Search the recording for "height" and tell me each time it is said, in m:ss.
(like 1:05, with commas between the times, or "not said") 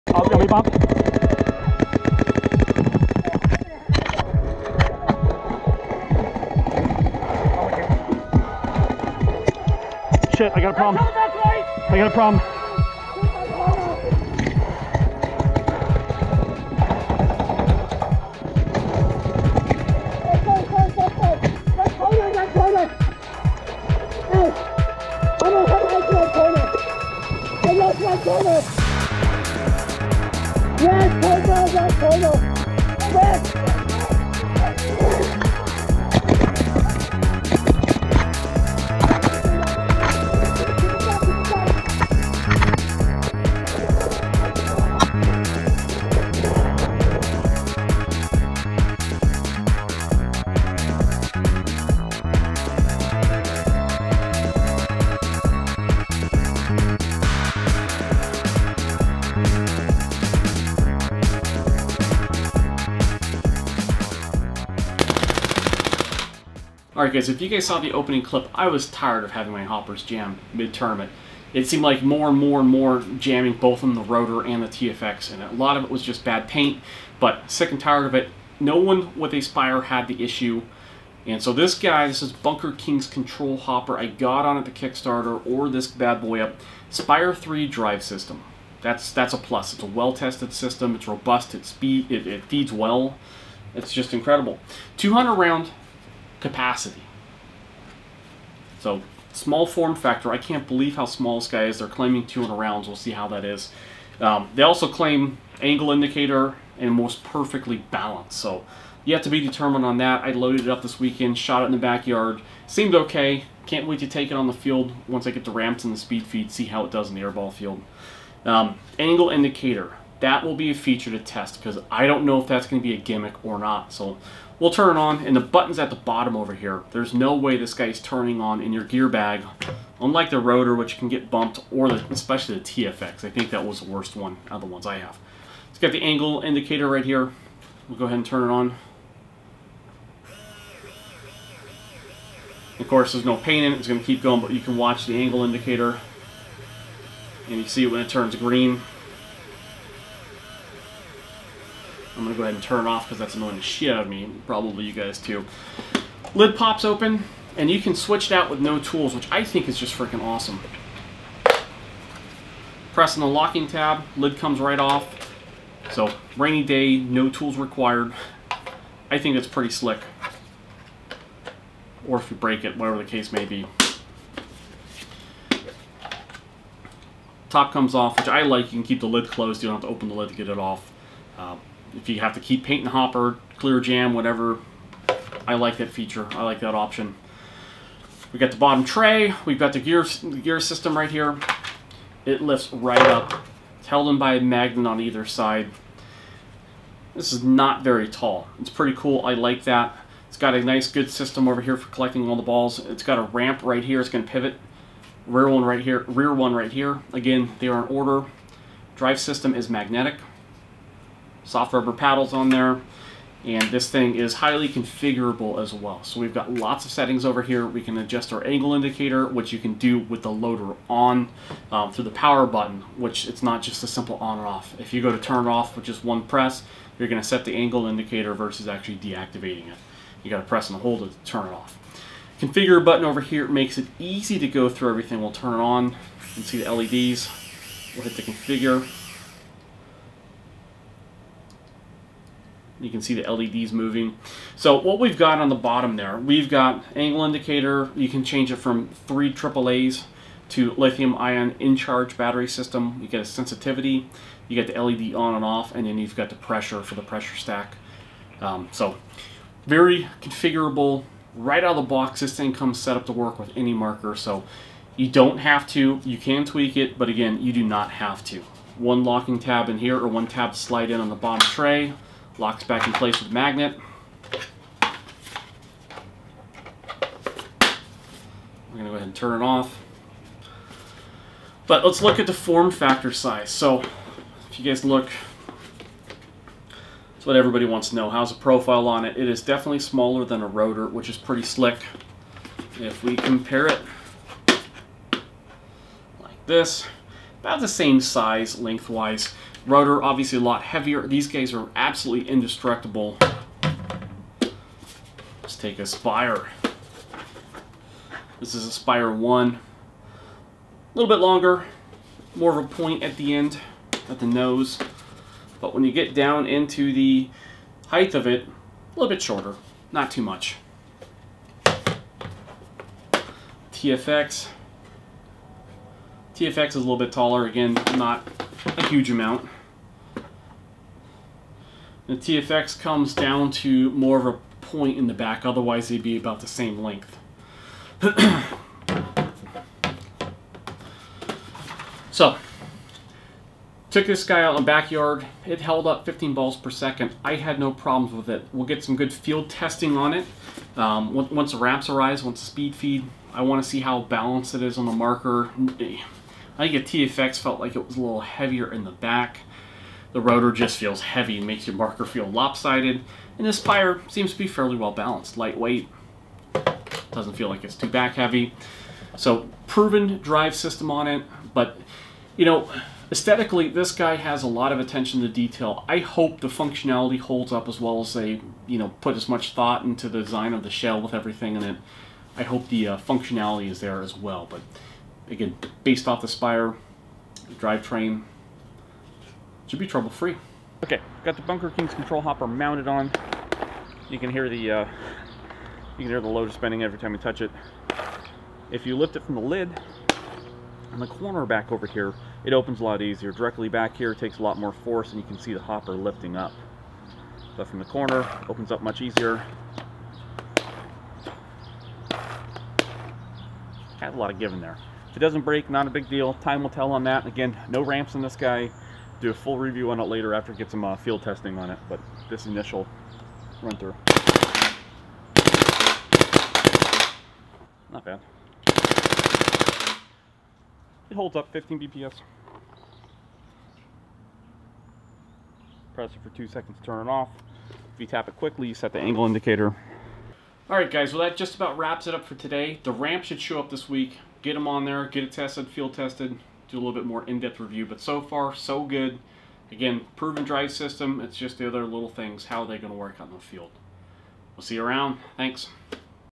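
5:17.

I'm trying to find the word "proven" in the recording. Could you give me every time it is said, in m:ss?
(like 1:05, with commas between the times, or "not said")
6:09, 7:30.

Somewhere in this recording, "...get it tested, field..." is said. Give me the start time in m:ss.
7:25.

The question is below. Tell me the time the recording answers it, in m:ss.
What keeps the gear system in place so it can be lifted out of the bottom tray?
3:14.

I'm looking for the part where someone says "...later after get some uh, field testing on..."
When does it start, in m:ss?
7:00.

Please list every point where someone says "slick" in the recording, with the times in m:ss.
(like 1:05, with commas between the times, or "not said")
2:49, 4:51.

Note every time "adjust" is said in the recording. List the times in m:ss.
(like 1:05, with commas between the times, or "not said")
3:37.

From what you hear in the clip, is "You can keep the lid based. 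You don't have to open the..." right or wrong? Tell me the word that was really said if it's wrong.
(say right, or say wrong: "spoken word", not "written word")
wrong: "closed", not "based".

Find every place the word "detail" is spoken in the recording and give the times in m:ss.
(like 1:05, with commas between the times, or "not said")
6:15.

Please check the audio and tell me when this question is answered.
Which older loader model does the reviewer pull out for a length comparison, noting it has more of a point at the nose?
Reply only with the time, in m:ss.
5:08.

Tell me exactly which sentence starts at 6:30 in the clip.
Okay, got the Bunker Kings control hopper mounted on.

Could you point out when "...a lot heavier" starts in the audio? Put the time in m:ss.
5:00.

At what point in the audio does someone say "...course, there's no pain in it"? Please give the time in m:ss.
2:22.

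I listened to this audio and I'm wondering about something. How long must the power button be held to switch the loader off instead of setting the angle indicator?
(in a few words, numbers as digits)
2 seconds.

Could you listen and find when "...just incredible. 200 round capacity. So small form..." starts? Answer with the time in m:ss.
1:33.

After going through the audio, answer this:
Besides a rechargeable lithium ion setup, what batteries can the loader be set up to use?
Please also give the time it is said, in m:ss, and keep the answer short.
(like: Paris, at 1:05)
Three AAAs, at 4:09.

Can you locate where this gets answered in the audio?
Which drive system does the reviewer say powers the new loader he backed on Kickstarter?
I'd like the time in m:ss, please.
1:26.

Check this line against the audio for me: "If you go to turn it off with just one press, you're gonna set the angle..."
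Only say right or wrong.
right.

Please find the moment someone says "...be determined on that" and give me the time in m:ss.
1:49.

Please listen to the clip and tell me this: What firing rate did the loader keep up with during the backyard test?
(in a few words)
15 balls per second.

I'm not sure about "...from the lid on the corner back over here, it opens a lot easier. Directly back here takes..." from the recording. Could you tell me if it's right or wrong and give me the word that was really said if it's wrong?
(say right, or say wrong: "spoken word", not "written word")
right.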